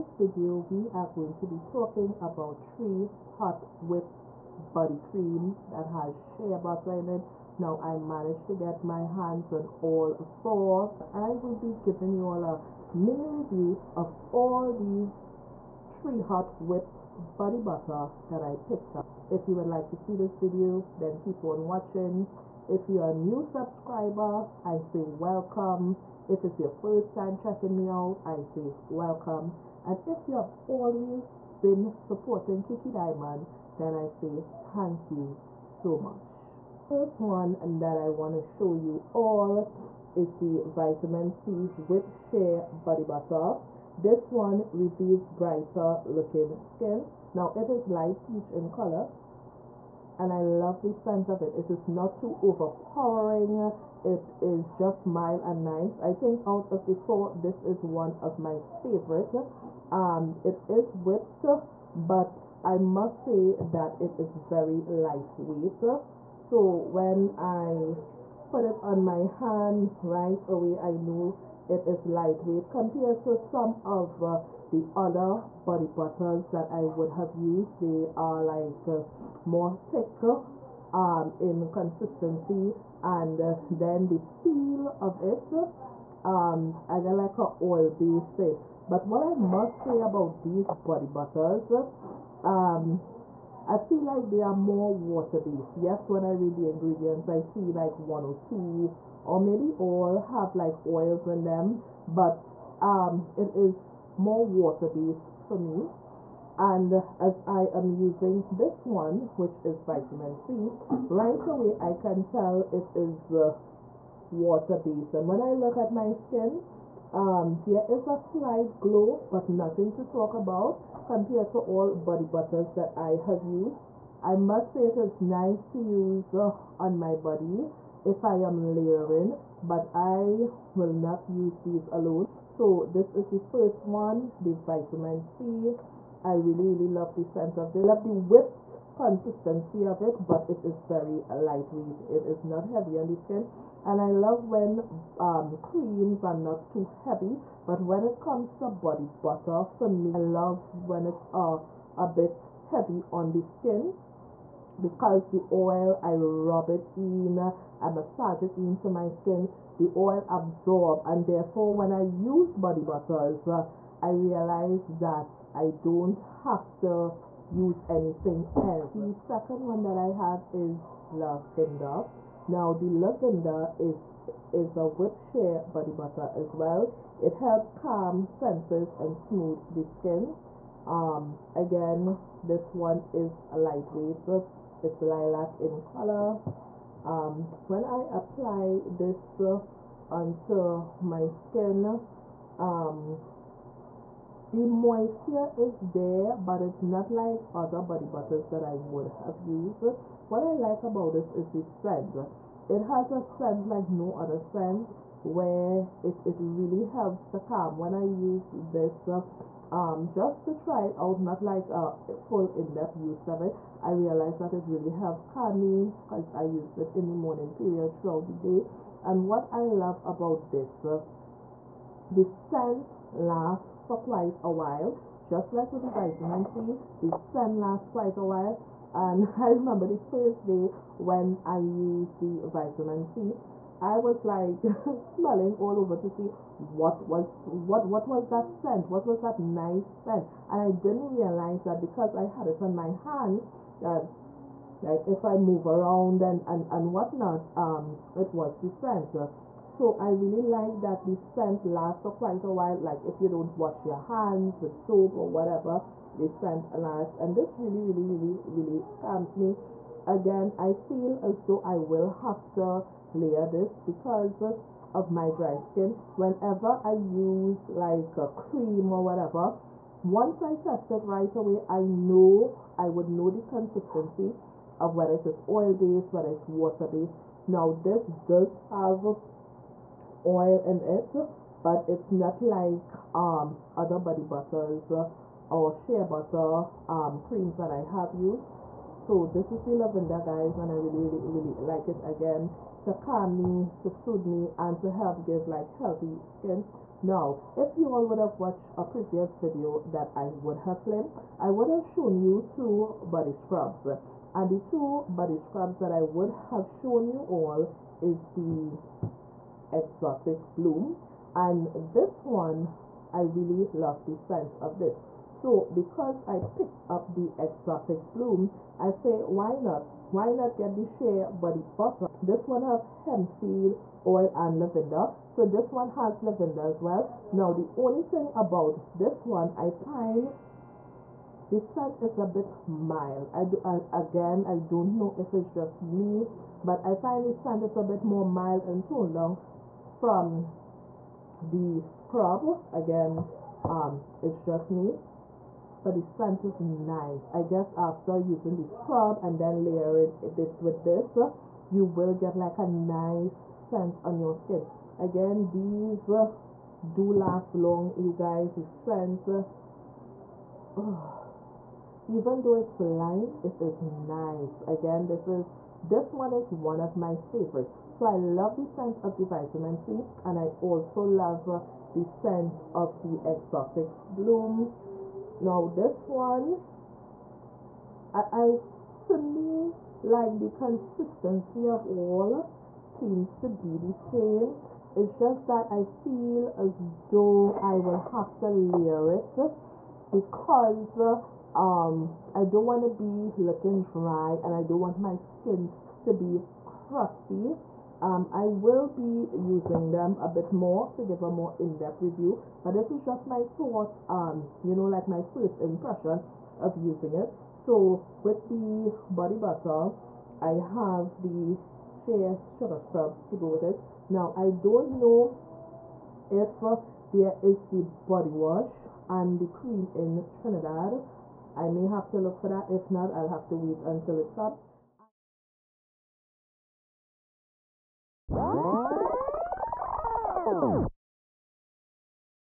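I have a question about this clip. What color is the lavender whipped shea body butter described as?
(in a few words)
Lilac.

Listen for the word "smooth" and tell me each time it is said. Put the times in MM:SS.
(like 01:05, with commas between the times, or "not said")
02:59.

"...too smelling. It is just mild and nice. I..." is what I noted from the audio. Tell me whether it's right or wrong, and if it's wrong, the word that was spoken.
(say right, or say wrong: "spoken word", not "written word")
wrong: "overpowering", not "smelling".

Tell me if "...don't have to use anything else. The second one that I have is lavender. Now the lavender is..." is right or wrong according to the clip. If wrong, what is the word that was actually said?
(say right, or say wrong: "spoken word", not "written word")
right.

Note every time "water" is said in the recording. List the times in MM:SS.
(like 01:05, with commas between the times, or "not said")
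01:34, 01:44, 01:54, 04:36.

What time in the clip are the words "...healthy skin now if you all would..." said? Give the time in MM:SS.
04:55.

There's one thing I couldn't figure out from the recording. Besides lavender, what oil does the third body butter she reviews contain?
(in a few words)
Hemp seed oil.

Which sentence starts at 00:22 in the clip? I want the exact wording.
If you're a new subscriber, I say welcome.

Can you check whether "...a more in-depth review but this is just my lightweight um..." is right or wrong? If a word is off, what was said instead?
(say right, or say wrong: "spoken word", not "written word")
wrong: "thought", not "lightweight".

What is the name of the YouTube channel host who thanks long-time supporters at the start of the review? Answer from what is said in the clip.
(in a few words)
Kiki Diamond.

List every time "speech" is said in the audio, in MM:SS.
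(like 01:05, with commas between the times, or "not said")
not said.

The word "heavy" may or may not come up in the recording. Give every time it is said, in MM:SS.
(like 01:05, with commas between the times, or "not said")
02:22, 02:27, 02:32.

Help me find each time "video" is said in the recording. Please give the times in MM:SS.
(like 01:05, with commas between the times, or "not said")
00:00, 00:20, 04:59.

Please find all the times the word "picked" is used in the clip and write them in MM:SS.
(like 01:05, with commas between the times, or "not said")
00:18, 05:16.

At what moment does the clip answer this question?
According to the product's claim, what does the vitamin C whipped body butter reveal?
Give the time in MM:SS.
00:45.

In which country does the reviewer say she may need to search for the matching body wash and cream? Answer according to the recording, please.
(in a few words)
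Trinidad.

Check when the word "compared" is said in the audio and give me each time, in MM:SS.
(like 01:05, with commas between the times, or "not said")
01:12, 02:01.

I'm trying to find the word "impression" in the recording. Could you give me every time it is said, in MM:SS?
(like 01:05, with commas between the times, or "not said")
06:45.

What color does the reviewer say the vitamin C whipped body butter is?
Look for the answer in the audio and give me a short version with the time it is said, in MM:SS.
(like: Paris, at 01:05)
Light peach, at 00:47.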